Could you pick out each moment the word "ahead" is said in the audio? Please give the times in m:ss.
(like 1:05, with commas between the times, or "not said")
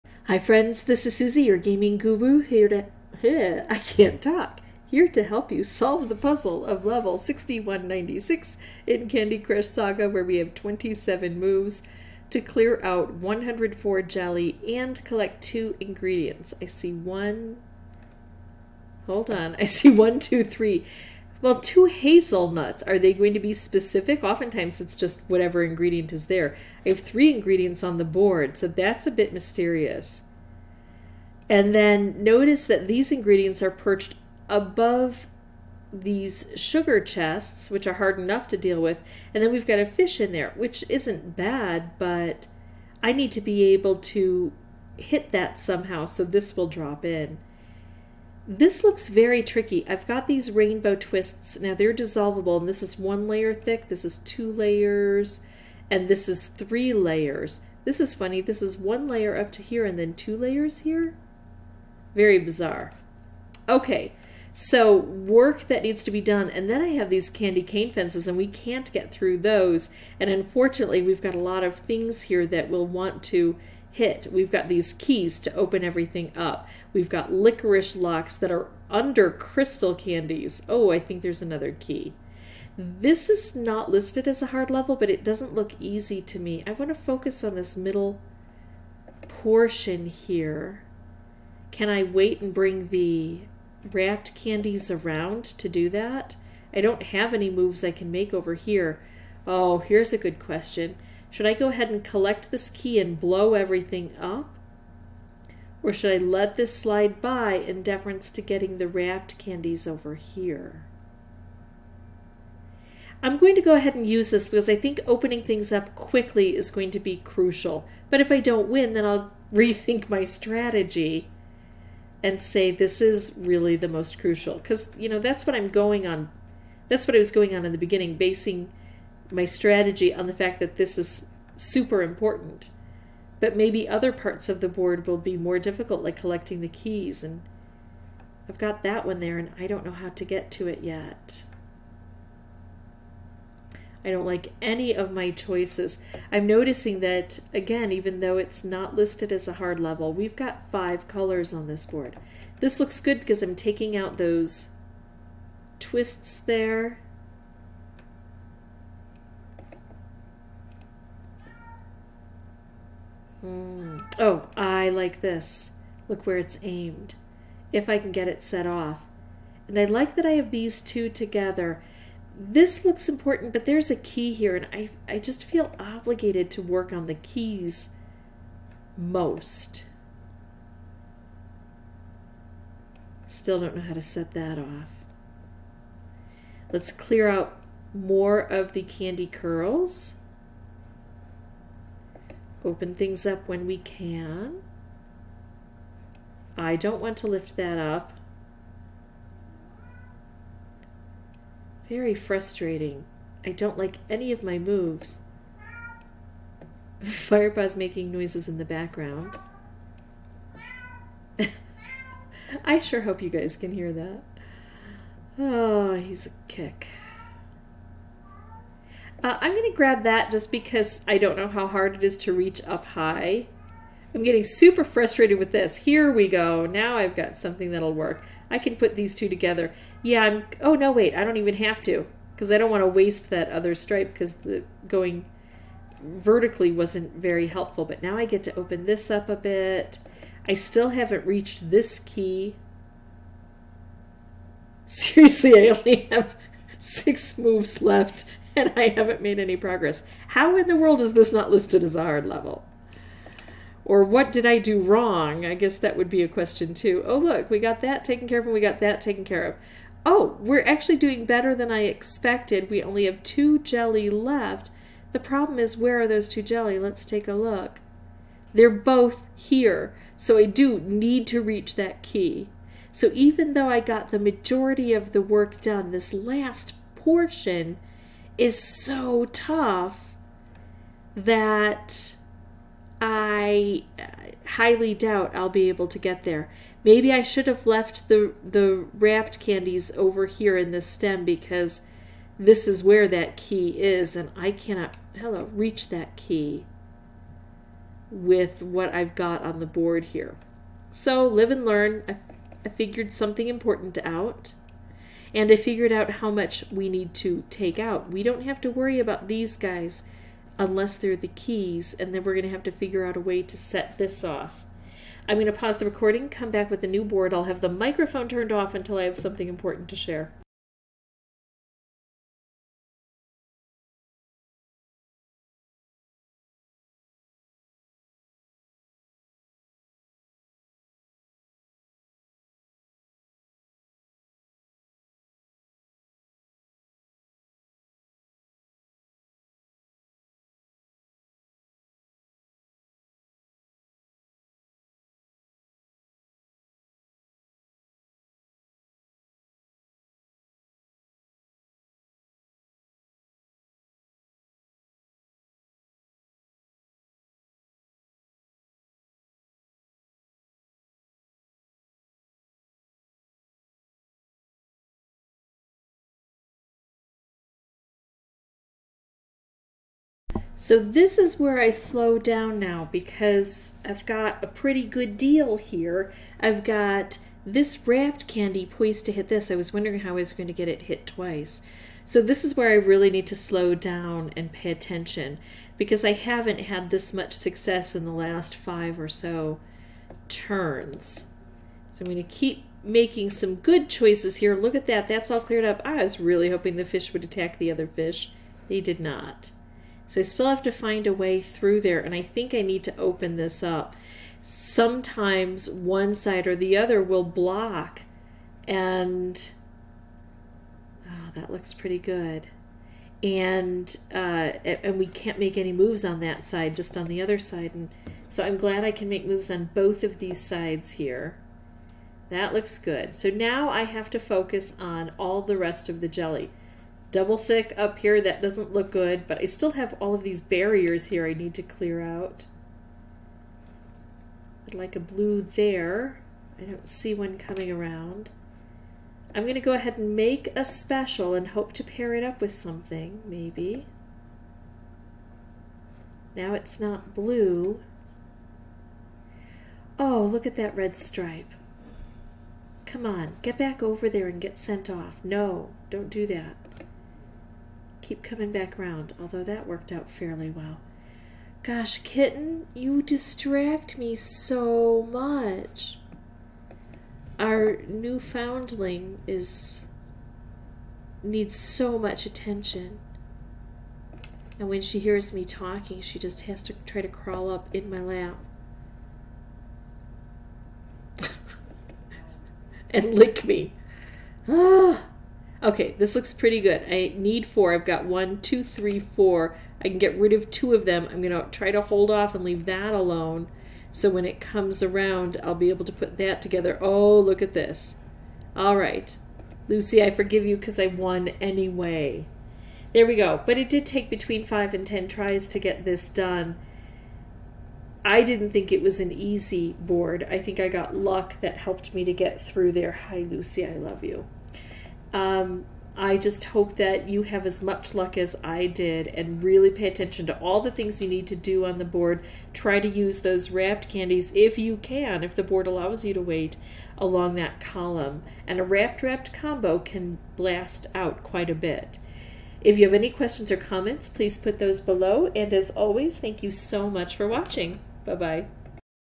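1:41, 1:53, 7:19.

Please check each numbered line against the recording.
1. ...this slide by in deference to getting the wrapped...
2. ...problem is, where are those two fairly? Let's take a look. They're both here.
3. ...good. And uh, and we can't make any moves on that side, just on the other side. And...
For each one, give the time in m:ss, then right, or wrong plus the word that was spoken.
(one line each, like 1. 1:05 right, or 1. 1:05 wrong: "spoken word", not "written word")
1. 1:46 right
2. 4:25 wrong: "jelly", not "fairly"
3. 6:51 right.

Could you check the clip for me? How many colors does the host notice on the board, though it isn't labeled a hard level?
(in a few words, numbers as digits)
5.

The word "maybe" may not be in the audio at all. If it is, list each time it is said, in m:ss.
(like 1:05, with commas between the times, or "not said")
2:13, 4:46, 7:23.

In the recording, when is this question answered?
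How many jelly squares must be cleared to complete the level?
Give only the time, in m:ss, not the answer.
0:13.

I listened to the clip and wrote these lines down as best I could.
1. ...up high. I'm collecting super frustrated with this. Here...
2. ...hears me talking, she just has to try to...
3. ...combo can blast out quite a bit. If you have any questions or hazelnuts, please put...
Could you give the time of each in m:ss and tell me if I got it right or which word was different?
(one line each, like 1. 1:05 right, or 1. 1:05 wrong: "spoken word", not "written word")
1. 3:42 wrong: "getting", not "collecting"
2. 7:54 right
3. 8:49 wrong: "comments", not "hazelnuts".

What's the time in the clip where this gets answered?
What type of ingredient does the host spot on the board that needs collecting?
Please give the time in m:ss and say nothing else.
0:21.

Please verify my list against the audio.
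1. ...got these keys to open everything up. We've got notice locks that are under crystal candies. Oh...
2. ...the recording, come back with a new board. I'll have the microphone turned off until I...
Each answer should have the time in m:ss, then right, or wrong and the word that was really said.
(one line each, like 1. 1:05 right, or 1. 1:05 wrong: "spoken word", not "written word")
1. 1:14 wrong: "licorice", not "notice"
2. 5:15 right.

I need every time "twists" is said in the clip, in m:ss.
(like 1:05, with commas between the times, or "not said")
0:50, 2:35.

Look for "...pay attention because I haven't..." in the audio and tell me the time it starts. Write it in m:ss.
6:24.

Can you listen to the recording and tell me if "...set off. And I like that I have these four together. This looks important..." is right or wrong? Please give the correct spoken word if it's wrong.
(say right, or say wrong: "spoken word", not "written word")
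wrong: "two", not "four".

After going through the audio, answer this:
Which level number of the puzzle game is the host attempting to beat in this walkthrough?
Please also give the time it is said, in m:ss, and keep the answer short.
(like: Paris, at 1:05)
6196, at 0:07.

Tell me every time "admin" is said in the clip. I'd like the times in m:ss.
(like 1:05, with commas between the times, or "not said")
not said.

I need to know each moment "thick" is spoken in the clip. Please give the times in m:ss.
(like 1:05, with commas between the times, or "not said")
0:53, 7:07.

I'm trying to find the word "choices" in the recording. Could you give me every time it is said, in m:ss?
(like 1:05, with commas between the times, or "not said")
2:25, 6:33.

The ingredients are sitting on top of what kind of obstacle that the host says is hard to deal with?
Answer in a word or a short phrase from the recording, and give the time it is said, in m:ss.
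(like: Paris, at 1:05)
sugar chests, at 0:36.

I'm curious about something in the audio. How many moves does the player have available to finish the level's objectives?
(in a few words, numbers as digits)
27.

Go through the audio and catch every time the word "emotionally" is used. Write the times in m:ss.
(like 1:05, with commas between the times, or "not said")
not said.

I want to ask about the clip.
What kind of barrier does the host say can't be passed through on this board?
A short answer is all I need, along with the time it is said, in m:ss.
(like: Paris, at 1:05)
candy cane fences, at 1:07.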